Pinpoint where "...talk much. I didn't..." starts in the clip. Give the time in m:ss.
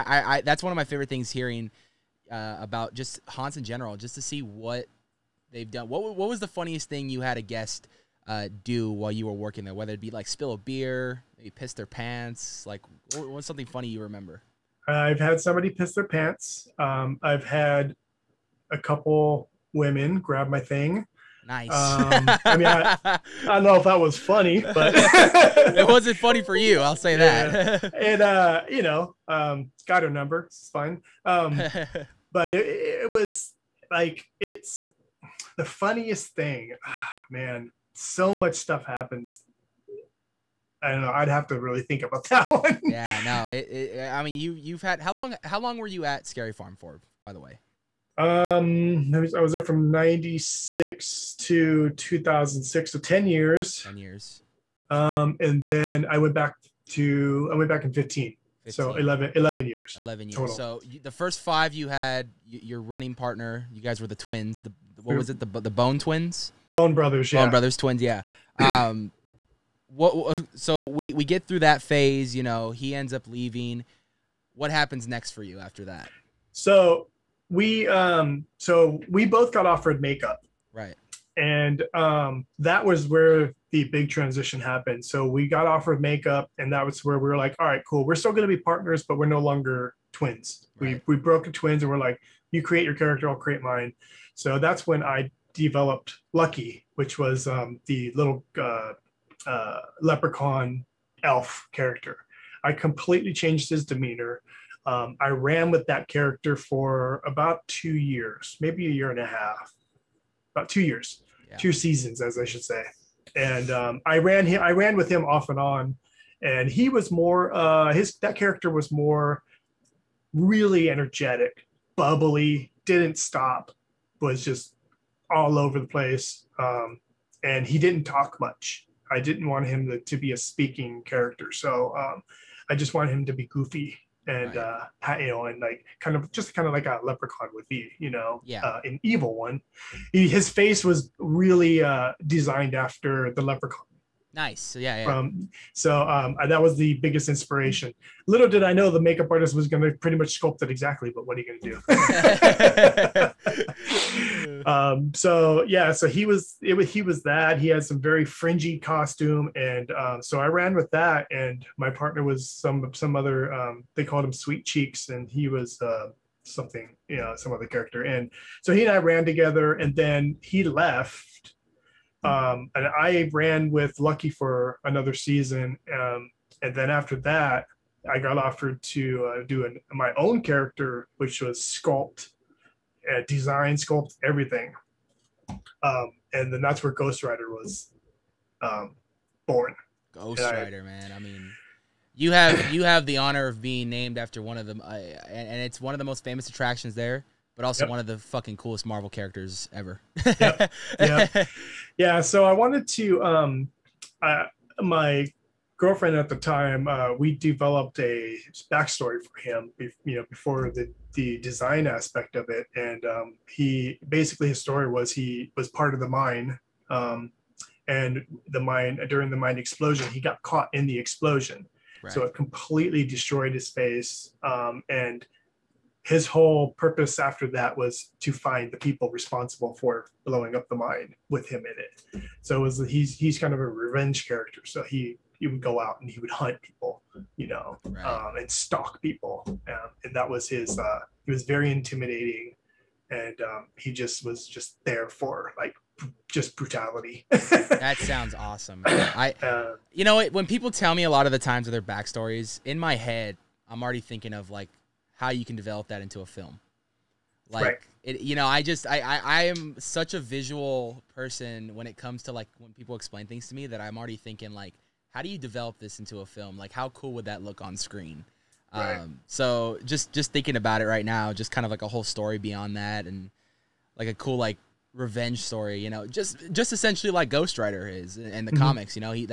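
2:08.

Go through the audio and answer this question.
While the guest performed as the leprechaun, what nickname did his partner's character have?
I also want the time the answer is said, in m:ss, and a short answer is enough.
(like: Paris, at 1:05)
Sweet Cheeks, at 2:44.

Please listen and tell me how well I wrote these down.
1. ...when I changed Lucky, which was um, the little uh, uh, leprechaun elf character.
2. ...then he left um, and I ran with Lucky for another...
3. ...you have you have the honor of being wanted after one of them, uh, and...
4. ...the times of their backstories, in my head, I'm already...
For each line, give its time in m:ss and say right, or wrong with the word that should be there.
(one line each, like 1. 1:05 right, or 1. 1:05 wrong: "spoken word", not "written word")
1. 1:34 wrong: "developed", not "changed"
2. 2:49 right
3. 3:12 wrong: "named", not "wanted"
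4. 4:11 right.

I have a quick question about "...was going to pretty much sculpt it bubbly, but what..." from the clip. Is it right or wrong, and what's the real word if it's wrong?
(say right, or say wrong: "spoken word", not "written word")
wrong: "exactly", not "bubbly".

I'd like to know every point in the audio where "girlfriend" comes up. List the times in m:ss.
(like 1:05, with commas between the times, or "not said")
3:25.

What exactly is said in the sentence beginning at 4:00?
Uh, he was very intimidating, and um, he just was just there for like just brutality.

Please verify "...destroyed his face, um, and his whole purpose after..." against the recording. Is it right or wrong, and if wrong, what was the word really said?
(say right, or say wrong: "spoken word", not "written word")
right.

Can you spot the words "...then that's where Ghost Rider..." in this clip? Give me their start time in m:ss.
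3:06.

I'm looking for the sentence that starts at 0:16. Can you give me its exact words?
Um, I've had a couple women grab my thing.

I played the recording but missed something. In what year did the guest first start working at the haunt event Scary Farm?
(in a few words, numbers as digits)
1996.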